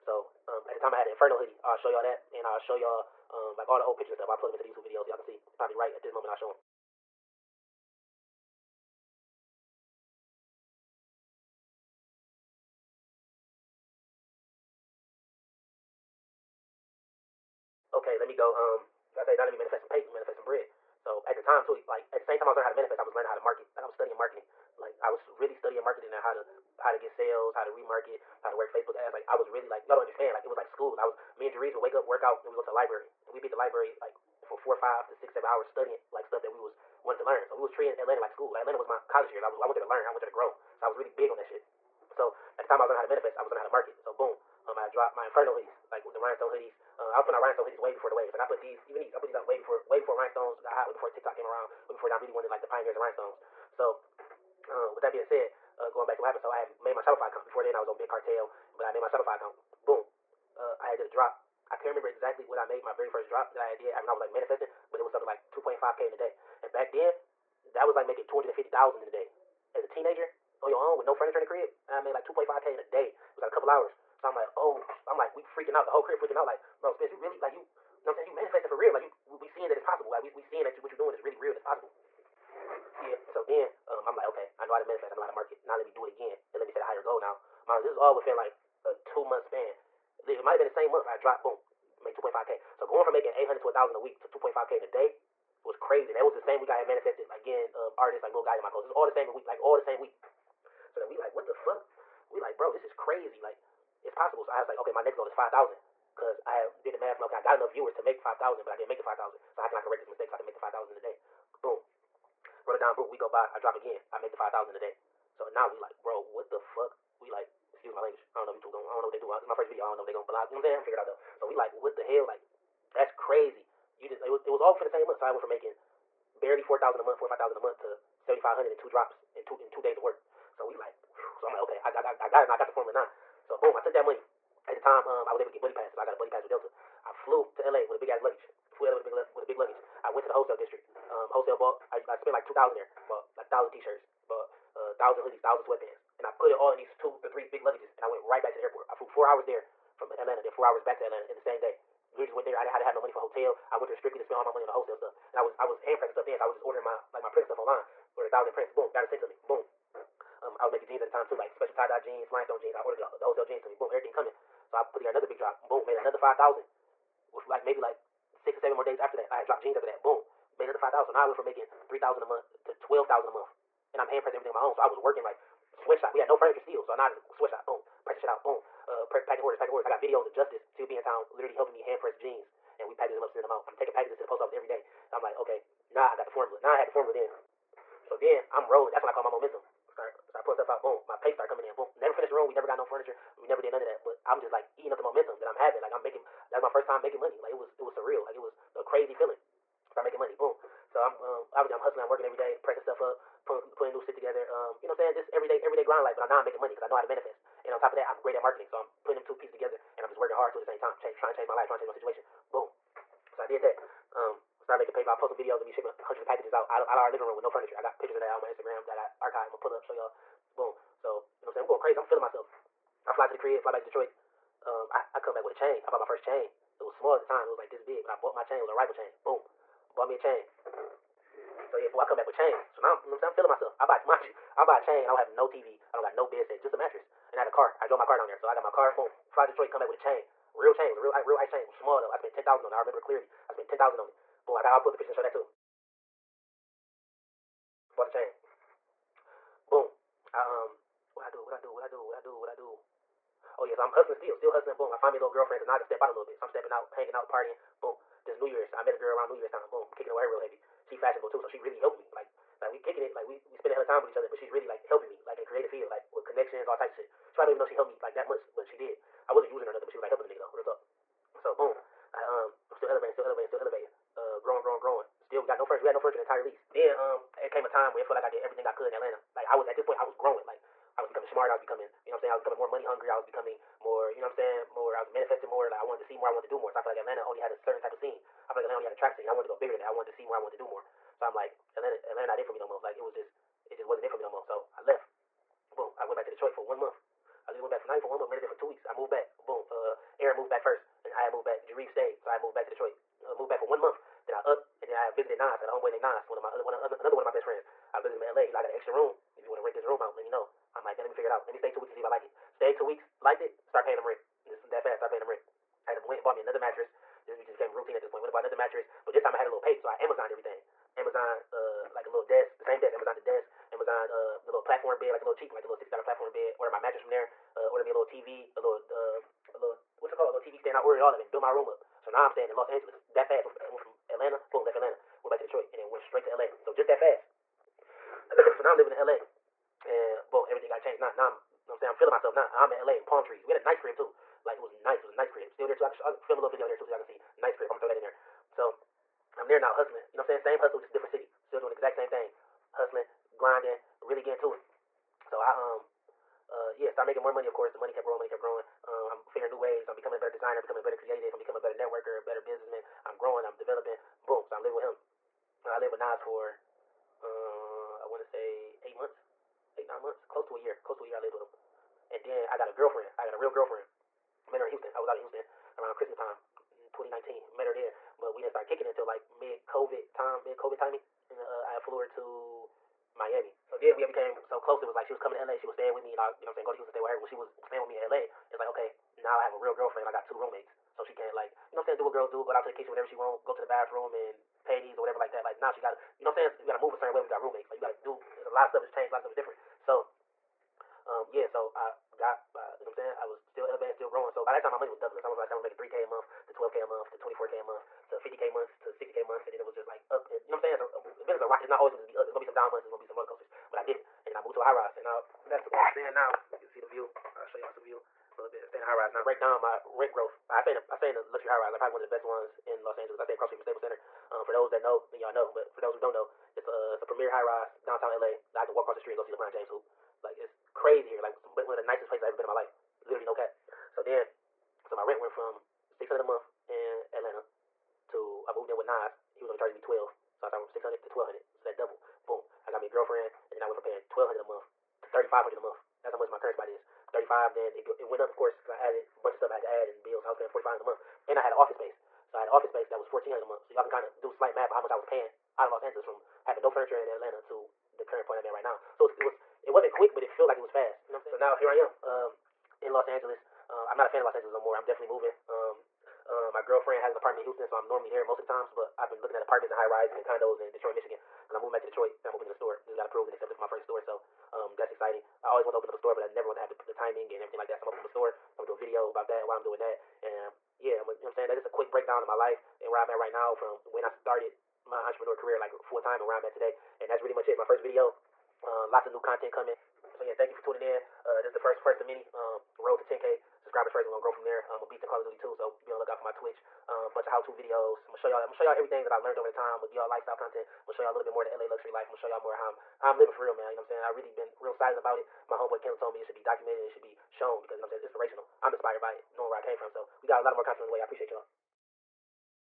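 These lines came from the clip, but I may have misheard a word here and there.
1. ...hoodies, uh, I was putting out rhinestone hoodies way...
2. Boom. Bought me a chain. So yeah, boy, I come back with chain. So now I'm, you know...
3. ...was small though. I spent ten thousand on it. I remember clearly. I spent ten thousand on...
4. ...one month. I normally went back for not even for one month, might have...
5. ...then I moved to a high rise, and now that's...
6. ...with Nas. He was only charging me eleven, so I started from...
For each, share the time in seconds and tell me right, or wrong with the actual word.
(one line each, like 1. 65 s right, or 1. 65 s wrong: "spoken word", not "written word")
1. 46 s right
2. 229 s right
3. 241 s right
4. 296 s wrong: "literally", not "normally"
5. 414 s right
6. 438 s wrong: "twelve", not "eleven".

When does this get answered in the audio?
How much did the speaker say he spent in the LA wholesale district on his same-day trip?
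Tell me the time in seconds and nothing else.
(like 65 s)
142 s.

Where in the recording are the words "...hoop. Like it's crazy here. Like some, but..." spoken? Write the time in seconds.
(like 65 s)
429 s.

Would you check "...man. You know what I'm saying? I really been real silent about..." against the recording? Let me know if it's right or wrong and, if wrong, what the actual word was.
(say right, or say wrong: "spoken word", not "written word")
right.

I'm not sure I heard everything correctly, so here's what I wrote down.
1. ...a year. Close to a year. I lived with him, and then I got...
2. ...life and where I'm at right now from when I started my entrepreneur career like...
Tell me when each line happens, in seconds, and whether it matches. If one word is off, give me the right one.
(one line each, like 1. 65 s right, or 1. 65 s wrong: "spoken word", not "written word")
1. 370 s right
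2. 482 s right.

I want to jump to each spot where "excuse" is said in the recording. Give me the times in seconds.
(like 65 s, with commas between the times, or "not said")
117 s.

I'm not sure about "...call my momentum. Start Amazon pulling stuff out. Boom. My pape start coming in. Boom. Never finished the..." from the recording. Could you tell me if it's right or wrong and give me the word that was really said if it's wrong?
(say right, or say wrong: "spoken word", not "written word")
wrong: "Start", not "Amazon".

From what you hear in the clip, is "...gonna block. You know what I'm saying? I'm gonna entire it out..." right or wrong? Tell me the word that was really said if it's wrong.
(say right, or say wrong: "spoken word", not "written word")
wrong: "figure", not "entire".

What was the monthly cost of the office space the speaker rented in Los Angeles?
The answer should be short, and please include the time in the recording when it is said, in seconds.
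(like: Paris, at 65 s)
1,400, at 453 s.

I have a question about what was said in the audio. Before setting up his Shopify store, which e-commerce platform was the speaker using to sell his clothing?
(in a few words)
Big Cartel.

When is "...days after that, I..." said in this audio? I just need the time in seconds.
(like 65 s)
168 s.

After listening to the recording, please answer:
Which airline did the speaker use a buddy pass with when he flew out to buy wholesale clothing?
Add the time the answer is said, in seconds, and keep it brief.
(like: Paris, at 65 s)
Delta, at 136 s.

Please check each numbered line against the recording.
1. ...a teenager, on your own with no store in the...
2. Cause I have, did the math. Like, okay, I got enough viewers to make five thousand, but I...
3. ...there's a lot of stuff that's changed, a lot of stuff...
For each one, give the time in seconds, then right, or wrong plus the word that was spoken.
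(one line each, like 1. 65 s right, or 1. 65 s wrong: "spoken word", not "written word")
1. 69 s wrong: "furniture", not "store"
2. 106 s right
3. 398 s right.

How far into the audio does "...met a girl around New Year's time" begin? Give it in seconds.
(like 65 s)
258 s.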